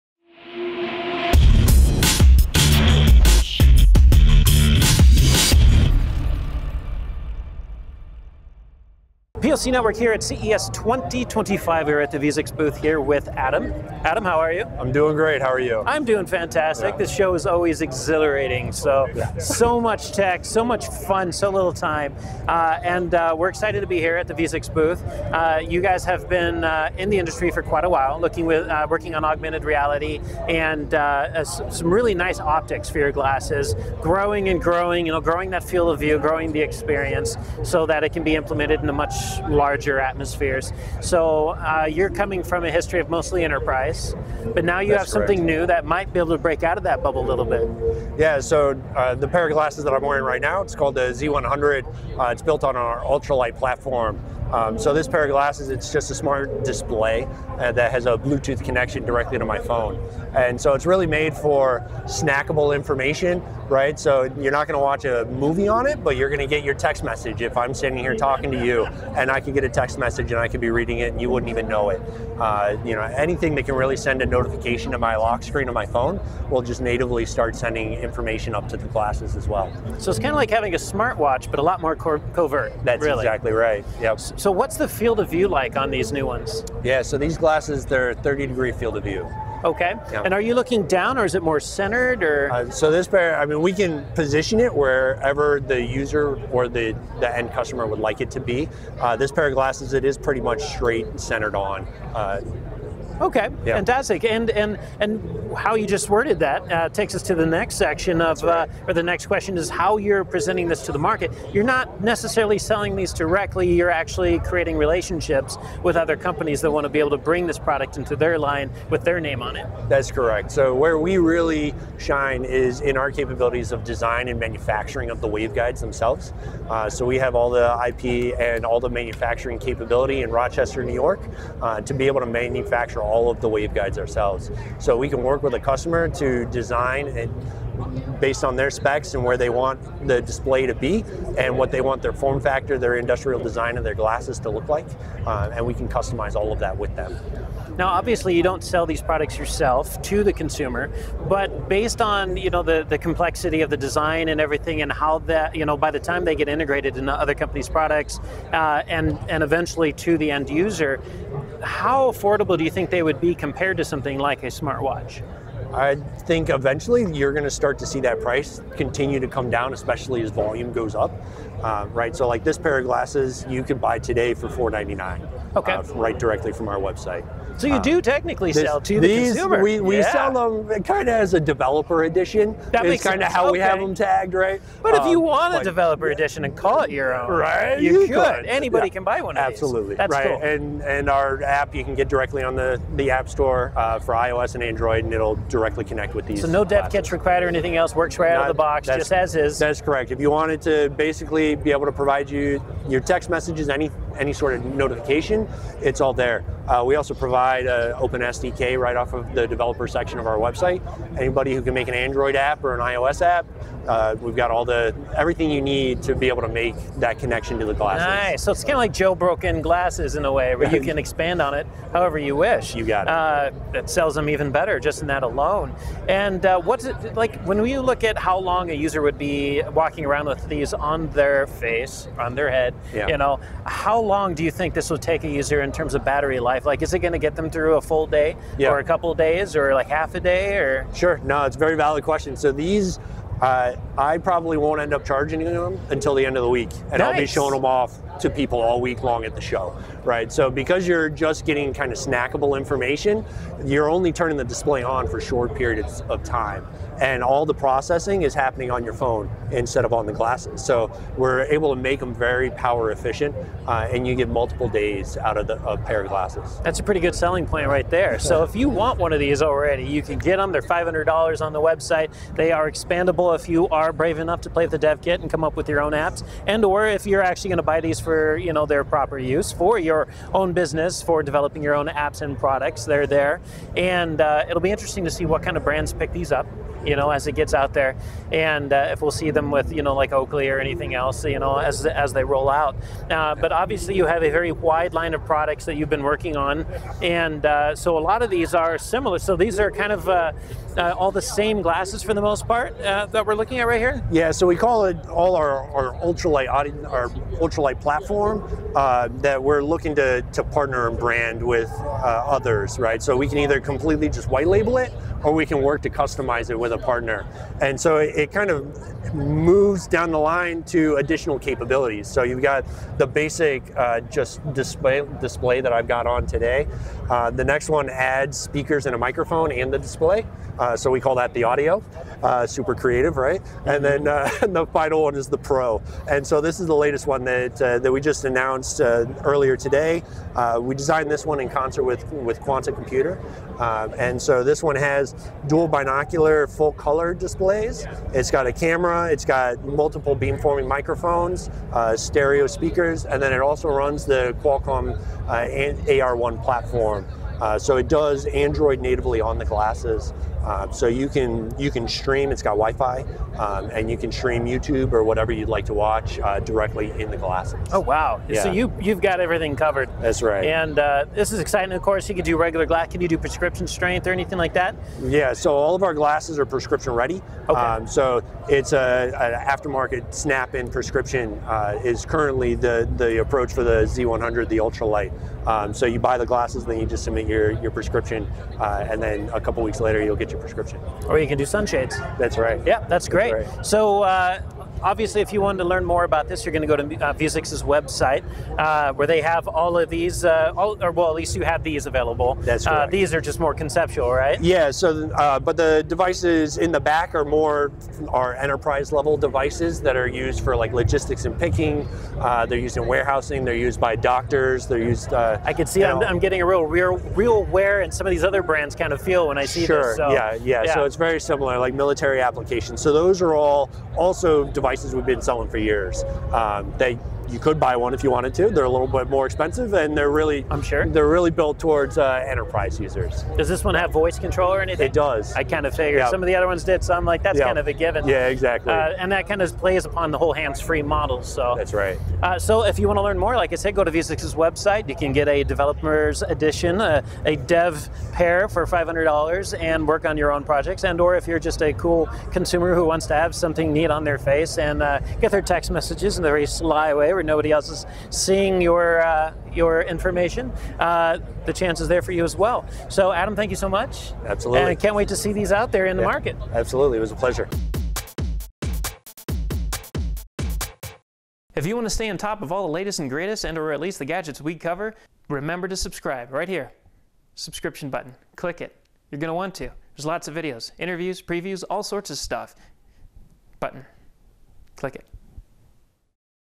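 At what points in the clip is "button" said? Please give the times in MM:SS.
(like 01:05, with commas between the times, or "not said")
07:57, 08:03.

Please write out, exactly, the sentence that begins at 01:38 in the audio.
Uh, this pair of glasses, it is pretty much straight and centered on.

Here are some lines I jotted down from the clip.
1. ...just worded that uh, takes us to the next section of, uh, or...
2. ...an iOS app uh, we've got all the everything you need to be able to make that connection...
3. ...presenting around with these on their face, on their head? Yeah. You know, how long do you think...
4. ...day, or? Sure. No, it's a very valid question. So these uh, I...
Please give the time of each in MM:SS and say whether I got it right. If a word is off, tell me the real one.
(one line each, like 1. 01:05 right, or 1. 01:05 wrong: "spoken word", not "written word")
1. 01:45 right
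2. 03:32 right
3. 03:49 wrong: "walking", not "presenting"
4. 04:00 right.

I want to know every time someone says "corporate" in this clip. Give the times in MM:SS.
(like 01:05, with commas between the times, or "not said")
not said.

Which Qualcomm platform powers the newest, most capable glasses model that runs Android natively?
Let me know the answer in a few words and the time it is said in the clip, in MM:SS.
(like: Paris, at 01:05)
Qualcomm AR1, at 05:54.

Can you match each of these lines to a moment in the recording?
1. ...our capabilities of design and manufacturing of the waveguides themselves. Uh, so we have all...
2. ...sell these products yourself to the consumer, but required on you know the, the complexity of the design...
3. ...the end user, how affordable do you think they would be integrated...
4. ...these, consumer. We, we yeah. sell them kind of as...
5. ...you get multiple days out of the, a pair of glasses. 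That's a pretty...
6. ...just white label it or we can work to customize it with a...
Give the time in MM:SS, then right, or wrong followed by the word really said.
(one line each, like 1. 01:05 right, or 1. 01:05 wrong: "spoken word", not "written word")
1. 02:02 right
2. 02:28 wrong: "based", not "required"
3. 02:40 wrong: "compared", not "integrated"
4. 02:59 right
5. 04:24 right
6. 05:14 right.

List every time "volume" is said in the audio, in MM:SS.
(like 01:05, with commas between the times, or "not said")
02:50.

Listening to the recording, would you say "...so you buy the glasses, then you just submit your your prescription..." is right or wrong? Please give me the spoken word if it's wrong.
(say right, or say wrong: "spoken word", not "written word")
right.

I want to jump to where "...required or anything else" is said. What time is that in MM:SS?
03:17.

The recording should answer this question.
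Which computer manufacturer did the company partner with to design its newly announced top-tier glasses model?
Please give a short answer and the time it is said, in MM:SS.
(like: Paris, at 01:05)
Quanta Computer, at 05:42.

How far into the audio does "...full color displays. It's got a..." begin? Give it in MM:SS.
05:46.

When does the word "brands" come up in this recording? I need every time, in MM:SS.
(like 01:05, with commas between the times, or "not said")
04:45, 05:10, 06:58.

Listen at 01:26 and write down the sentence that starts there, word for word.
Yeah, so these glasses, they're 30 degree field of view.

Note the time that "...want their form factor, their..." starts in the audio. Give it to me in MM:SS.
02:21.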